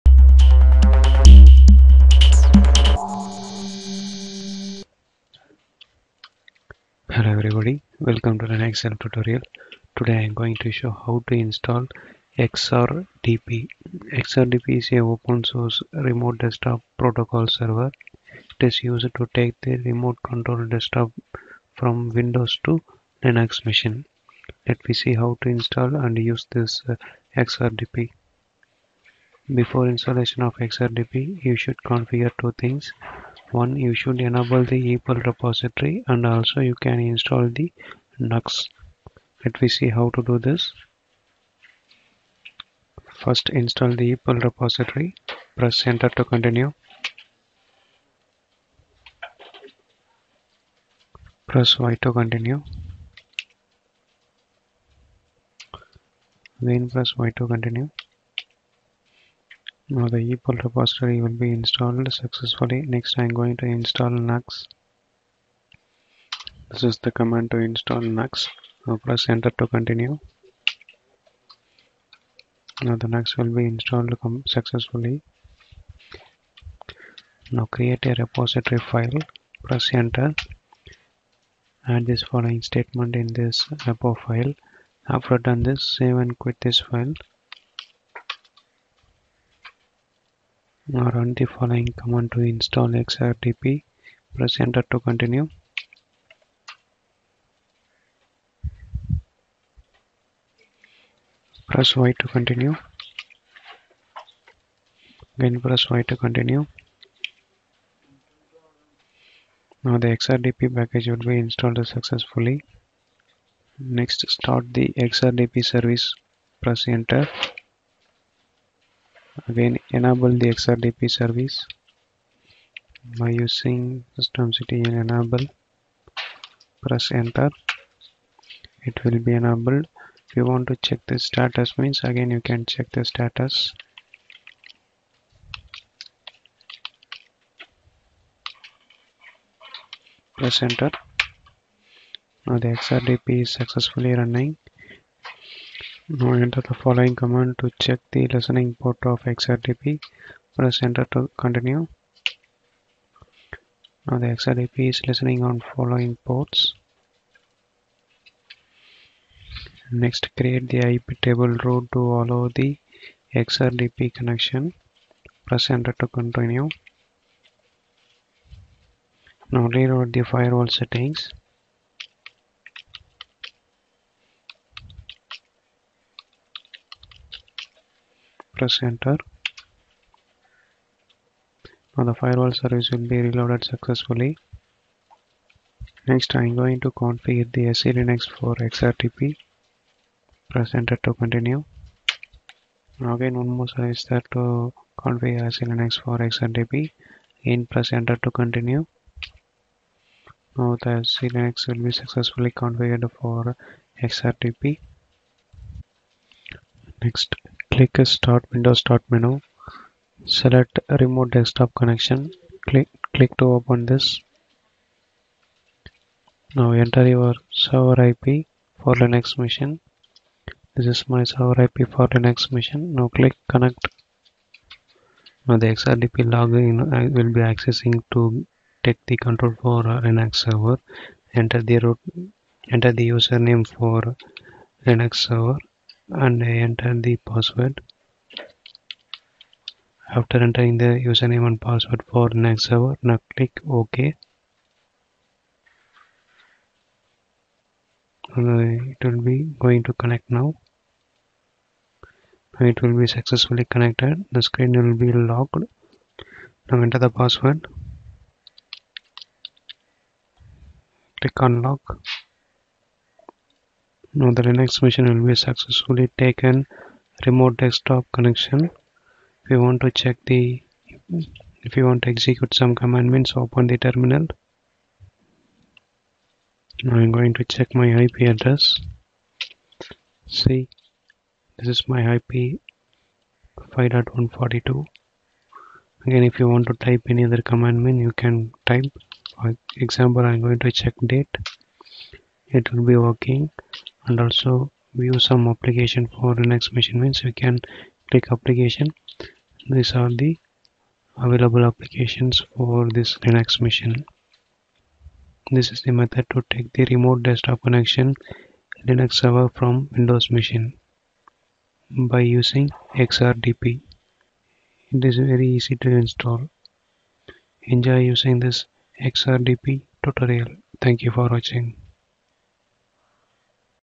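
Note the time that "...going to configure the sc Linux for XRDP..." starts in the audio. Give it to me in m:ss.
3:06.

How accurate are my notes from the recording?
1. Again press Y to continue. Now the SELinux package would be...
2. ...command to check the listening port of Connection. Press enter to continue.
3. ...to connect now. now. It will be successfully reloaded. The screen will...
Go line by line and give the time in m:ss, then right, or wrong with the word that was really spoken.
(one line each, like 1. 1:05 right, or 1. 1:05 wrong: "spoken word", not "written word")
1. 1:45 wrong: "XRDP", not "SELinux"
2. 2:27 wrong: "XRDP", not "Connection"
3. 4:09 wrong: "connected", not "reloaded".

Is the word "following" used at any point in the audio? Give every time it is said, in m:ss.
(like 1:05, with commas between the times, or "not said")
1:22, 1:31, 2:26, 2:35.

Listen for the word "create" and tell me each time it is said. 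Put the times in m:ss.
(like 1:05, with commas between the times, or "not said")
1:17, 2:40.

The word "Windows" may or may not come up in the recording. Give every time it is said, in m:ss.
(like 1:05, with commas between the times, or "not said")
0:22, 3:28, 5:09.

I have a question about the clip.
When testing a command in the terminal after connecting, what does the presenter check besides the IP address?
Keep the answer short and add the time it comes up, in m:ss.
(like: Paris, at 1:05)
date, at 4:51.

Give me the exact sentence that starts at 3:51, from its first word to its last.
Enter the root, enter the username for Linux server and I enter the password.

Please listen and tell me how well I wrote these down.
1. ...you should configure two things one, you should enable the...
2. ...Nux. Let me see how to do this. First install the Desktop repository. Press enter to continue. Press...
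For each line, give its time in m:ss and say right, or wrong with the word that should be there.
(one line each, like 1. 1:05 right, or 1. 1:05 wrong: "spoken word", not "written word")
1. 0:31 right
2. 0:38 wrong: "EPEL", not "Desktop".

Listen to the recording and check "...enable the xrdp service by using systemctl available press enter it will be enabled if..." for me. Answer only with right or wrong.
wrong.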